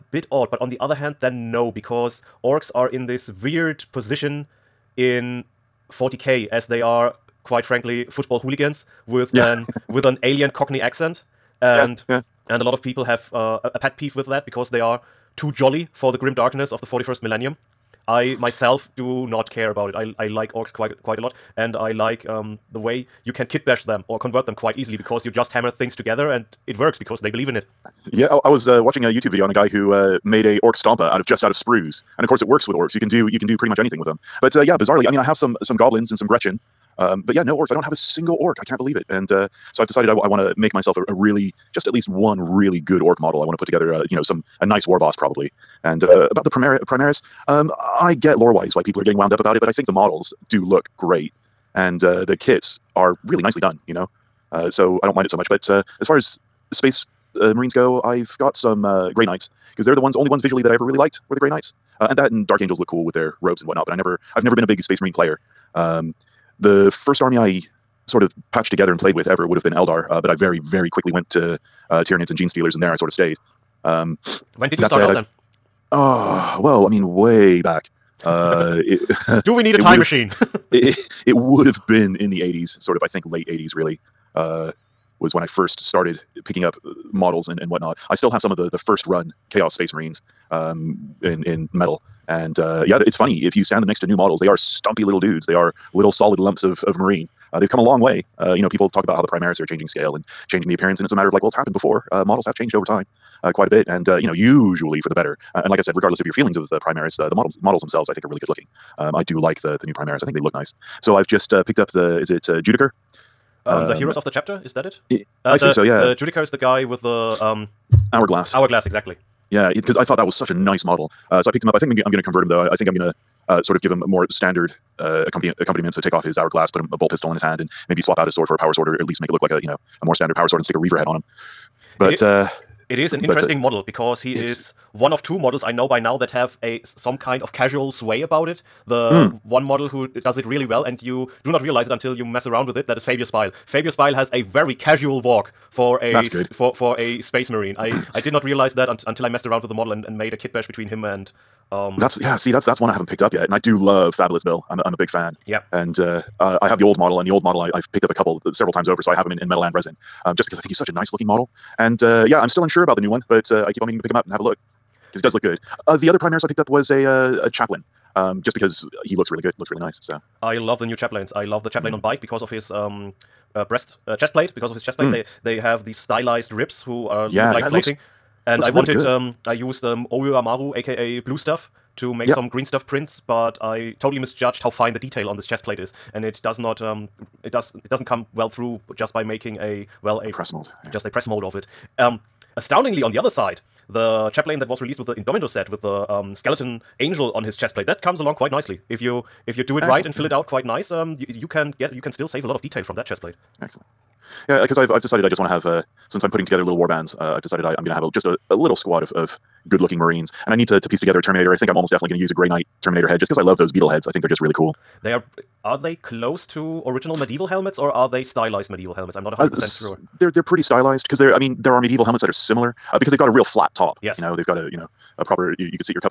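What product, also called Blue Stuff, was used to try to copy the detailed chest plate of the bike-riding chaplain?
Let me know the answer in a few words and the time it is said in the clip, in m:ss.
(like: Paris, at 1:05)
Oyumaru, at 3:00.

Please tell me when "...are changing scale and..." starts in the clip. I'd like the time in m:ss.
1:39.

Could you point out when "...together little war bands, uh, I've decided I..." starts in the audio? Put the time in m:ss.
3:26.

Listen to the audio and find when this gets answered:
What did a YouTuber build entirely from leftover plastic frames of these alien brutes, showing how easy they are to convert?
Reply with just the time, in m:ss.
0:30.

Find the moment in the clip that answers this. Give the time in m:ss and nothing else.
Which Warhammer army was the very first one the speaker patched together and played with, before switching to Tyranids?
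1:09.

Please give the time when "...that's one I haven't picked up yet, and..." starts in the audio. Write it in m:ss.
2:32.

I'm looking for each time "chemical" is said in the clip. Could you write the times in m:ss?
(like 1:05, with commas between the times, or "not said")
not said.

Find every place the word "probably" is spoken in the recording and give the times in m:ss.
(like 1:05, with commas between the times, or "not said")
0:45.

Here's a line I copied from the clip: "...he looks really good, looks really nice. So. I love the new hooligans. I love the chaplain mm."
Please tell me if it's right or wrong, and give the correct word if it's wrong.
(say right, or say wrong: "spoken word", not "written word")
wrong: "chaplains", not "hooligans".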